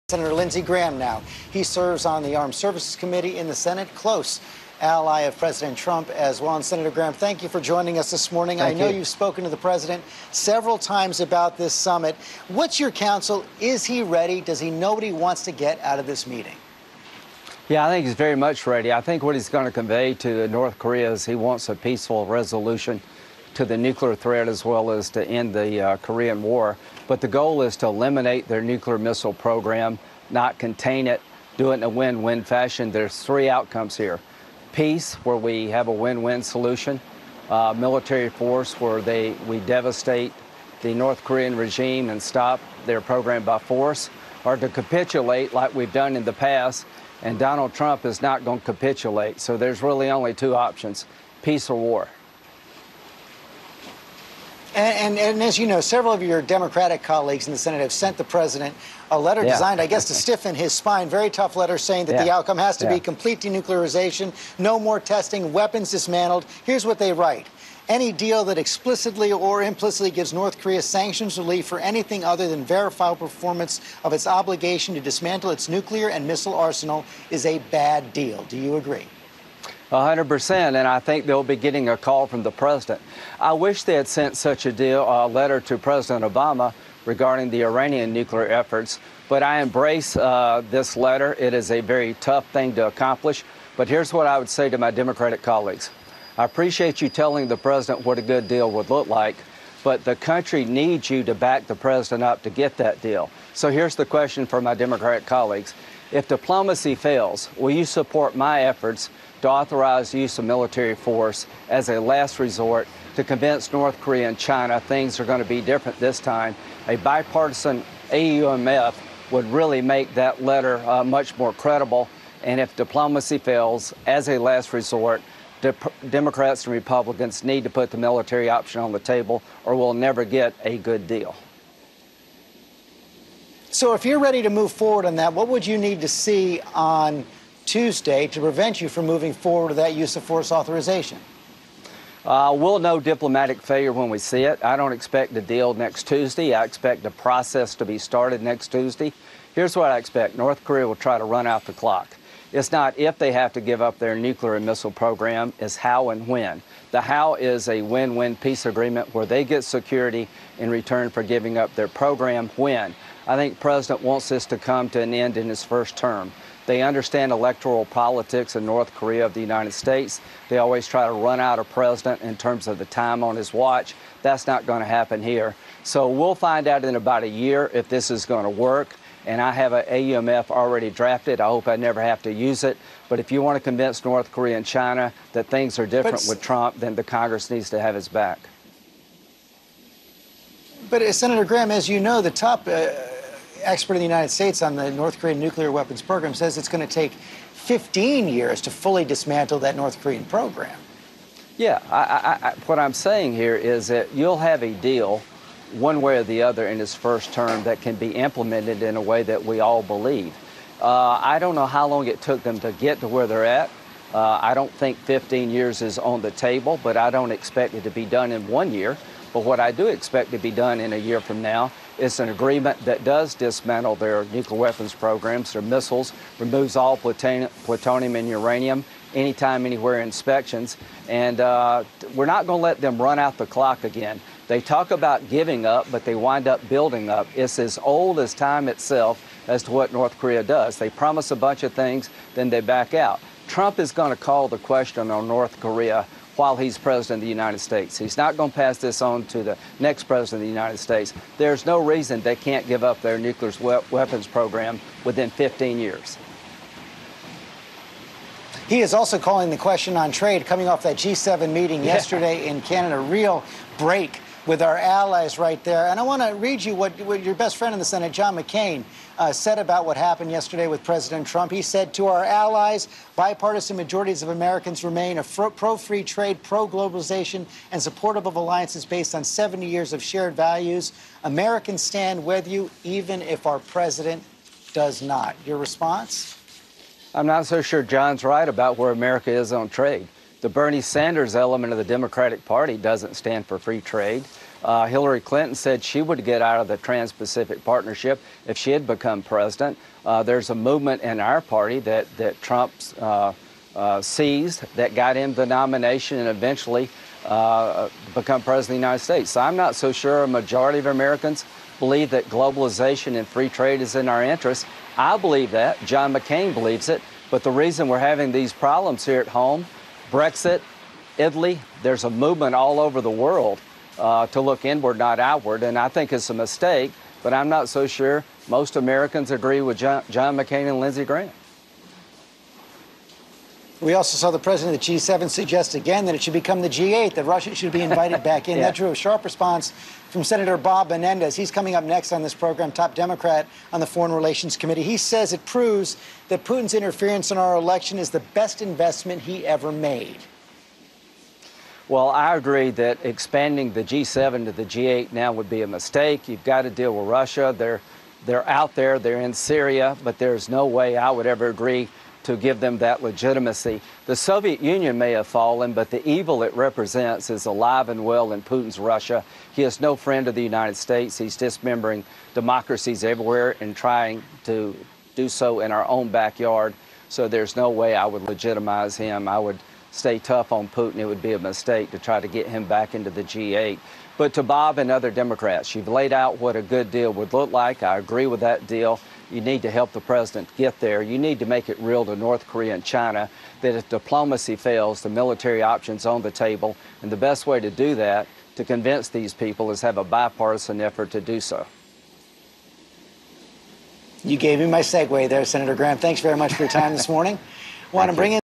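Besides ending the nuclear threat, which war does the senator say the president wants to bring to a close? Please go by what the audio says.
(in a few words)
Korean War.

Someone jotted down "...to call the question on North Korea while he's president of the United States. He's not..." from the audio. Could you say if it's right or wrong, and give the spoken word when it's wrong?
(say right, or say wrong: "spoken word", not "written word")
right.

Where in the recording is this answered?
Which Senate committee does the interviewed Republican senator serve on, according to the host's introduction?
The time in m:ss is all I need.
0:02.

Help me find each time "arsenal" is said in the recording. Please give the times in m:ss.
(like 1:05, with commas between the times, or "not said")
1:16.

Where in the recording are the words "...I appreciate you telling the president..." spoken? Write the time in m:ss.
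1:36.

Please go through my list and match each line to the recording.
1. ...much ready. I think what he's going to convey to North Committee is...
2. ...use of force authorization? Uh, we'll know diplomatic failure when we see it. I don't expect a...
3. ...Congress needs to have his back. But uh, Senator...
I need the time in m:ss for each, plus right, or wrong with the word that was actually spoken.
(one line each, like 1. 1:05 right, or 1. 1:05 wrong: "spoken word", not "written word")
1. 0:18 wrong: "Korea", not "Committee"
2. 2:19 right
3. 3:07 right.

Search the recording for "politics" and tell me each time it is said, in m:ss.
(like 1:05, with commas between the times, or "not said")
2:47.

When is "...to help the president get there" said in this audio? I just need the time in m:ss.
6:29.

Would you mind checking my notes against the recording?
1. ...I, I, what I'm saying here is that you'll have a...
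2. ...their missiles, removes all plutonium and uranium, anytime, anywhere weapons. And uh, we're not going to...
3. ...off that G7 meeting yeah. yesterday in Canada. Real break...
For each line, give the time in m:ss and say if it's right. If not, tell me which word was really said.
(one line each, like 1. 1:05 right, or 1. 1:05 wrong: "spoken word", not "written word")
1. 3:22 right
2. 3:45 wrong: "inspections", not "weapons"
3. 4:20 right.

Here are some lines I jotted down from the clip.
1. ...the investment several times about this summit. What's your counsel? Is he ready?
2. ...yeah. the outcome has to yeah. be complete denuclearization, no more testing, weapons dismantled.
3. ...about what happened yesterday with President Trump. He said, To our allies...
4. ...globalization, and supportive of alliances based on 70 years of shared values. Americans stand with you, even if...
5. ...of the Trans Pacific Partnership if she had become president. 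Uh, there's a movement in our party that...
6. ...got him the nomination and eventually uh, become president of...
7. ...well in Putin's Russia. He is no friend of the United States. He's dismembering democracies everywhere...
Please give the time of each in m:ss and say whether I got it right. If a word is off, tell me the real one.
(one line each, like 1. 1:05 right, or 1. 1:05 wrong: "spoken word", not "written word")
1. 0:09 wrong: "president", not "investment"
2. 1:02 right
3. 4:29 right
4. 4:36 right
5. 4:56 right
6. 5:04 right
7. 6:08 right.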